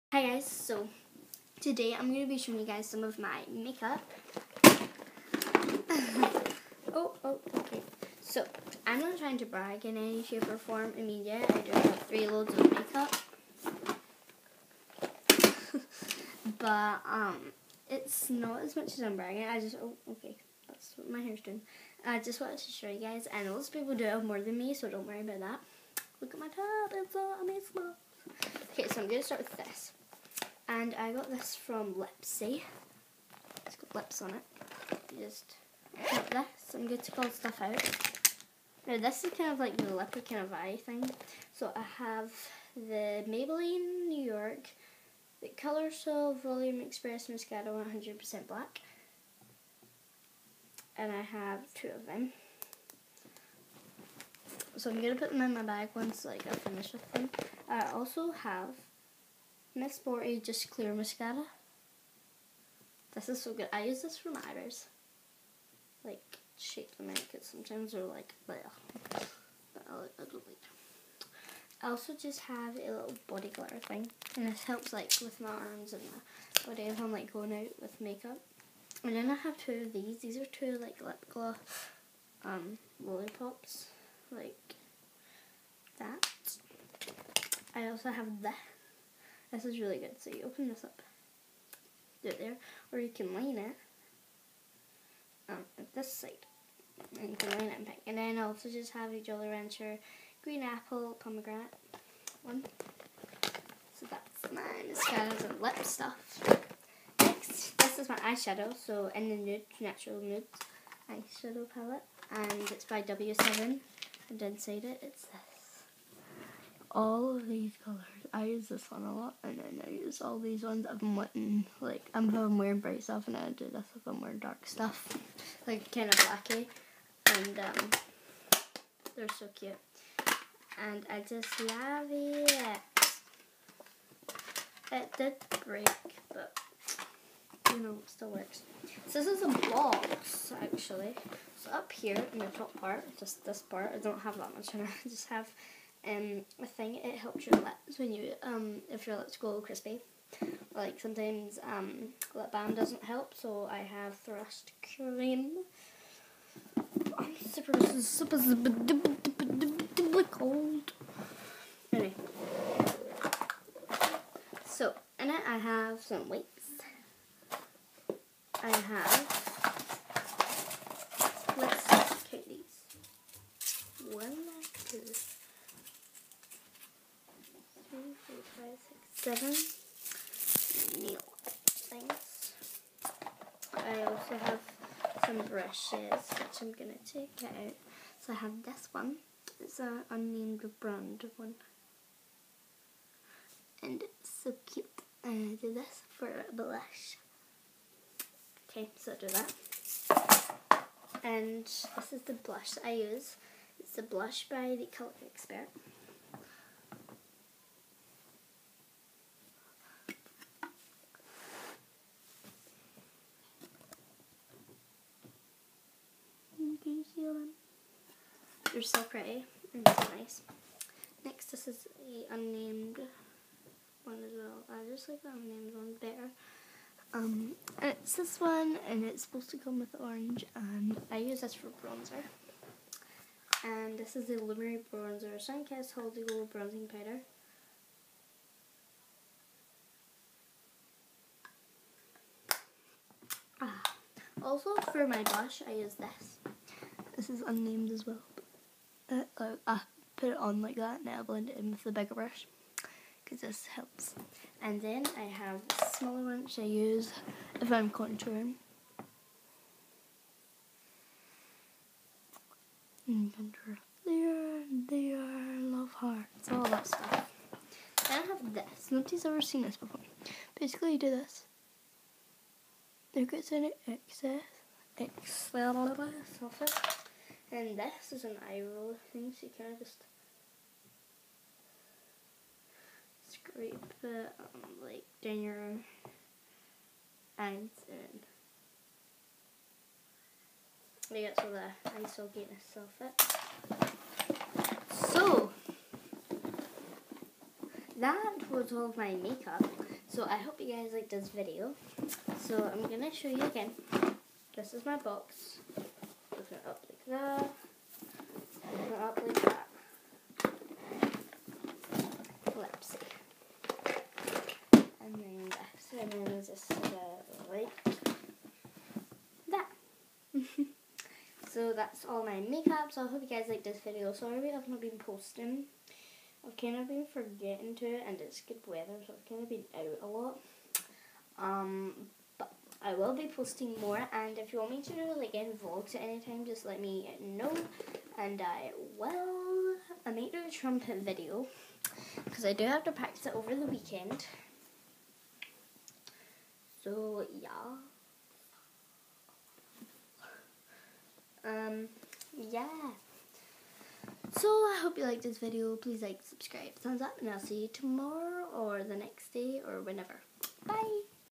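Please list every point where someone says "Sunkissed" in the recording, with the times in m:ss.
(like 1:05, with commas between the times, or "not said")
3:55.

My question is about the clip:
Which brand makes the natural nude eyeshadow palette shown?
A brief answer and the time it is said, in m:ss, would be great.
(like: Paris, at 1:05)
W7, at 1:53.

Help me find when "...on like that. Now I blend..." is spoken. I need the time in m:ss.
4:10.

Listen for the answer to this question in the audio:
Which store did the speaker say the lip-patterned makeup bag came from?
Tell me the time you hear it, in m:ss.
0:31.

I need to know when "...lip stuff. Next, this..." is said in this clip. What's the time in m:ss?
1:45.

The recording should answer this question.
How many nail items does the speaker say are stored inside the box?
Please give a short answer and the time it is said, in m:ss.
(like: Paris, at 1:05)
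7, at 2:59.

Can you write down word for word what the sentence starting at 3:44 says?
I just like the unnamed one better.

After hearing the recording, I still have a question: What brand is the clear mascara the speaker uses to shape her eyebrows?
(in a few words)
Miss Sporty.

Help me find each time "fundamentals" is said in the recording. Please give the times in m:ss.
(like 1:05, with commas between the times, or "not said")
not said.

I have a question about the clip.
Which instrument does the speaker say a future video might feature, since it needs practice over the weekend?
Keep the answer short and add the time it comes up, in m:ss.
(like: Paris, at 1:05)
Trumpet, at 5:40.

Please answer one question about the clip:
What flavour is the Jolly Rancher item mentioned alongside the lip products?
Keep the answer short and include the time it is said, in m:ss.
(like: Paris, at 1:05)
Green apple pomegranate, at 1:40.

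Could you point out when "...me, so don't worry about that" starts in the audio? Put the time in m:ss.
0:24.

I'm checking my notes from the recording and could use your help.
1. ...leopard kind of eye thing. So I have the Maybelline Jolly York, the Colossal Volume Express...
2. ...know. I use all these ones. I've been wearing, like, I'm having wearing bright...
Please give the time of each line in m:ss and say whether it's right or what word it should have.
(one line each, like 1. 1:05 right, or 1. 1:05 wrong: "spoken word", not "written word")
1. 0:39 wrong: "New", not "Jolly"
2. 1:59 wrong: "wanting", not "wearing".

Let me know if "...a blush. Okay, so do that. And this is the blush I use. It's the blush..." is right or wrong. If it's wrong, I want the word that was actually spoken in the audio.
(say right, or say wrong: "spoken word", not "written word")
right.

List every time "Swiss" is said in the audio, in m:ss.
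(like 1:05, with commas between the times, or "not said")
not said.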